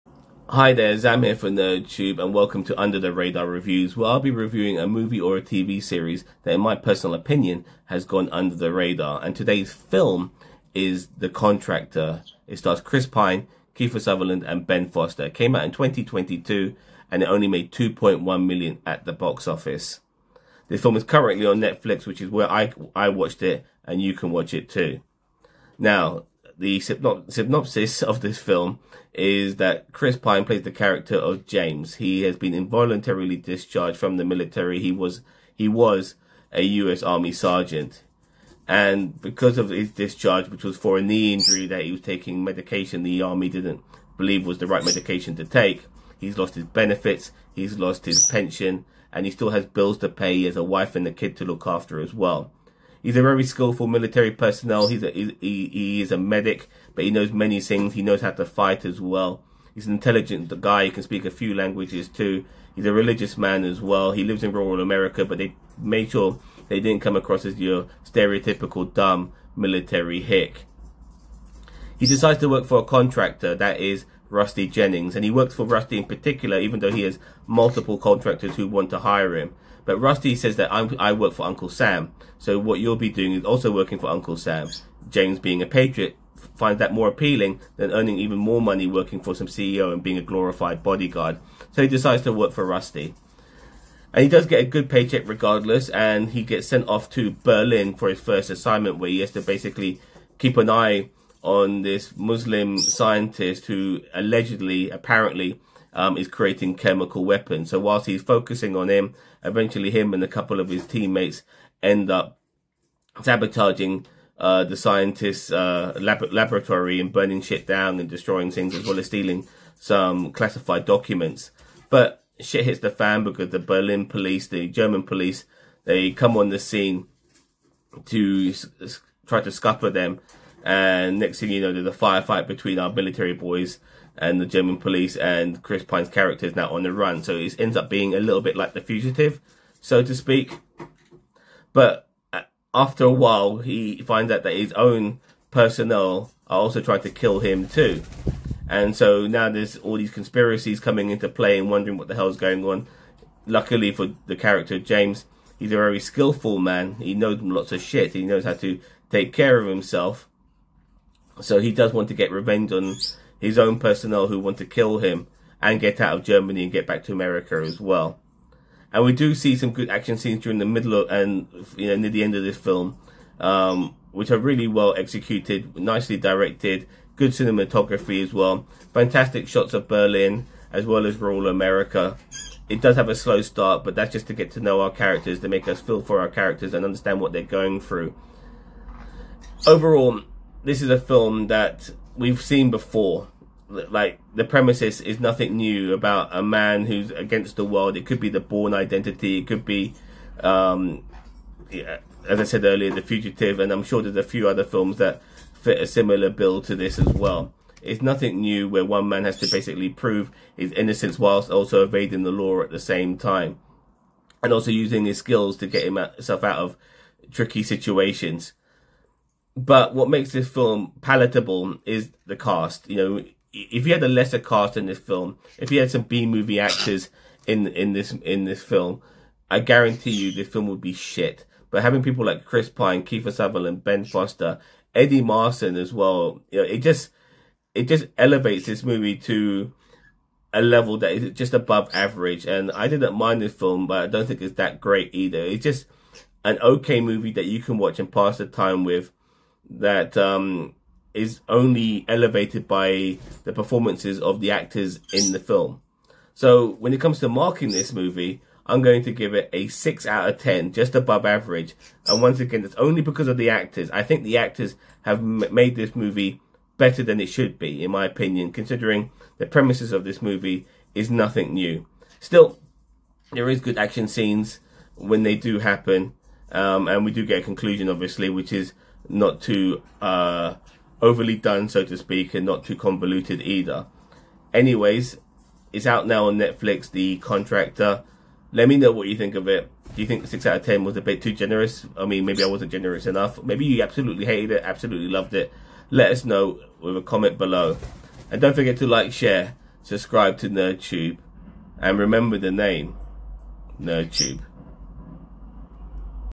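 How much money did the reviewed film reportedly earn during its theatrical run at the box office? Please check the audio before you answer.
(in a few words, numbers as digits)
2.1 million.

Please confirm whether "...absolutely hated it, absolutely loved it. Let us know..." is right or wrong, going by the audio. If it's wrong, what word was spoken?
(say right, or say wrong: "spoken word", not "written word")
right.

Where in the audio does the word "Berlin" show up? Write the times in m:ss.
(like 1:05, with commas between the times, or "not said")
1:37, 2:03, 2:59.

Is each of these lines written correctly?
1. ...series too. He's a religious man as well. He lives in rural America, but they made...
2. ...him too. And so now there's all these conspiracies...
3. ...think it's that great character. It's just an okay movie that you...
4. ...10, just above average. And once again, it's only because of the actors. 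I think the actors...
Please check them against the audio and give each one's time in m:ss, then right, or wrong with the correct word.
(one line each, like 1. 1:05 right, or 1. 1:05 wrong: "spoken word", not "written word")
1. 1:01 wrong: "languages", not "series"
2. 2:27 right
3. 4:04 wrong: "either", not "character"
4. 4:20 right.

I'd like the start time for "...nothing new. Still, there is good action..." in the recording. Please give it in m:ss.
4:31.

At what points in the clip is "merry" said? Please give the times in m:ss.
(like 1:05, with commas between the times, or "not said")
not said.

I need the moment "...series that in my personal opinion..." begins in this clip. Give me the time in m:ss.
0:05.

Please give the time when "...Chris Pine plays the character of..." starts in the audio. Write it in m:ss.
0:29.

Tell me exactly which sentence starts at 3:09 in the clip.
Overall, this is a film that we've seen before.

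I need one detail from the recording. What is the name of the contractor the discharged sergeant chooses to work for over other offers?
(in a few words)
Rusty Jennings.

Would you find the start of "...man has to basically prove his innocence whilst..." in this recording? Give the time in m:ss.
3:29.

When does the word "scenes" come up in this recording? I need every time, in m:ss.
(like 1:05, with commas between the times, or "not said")
2:06, 2:50, 4:34.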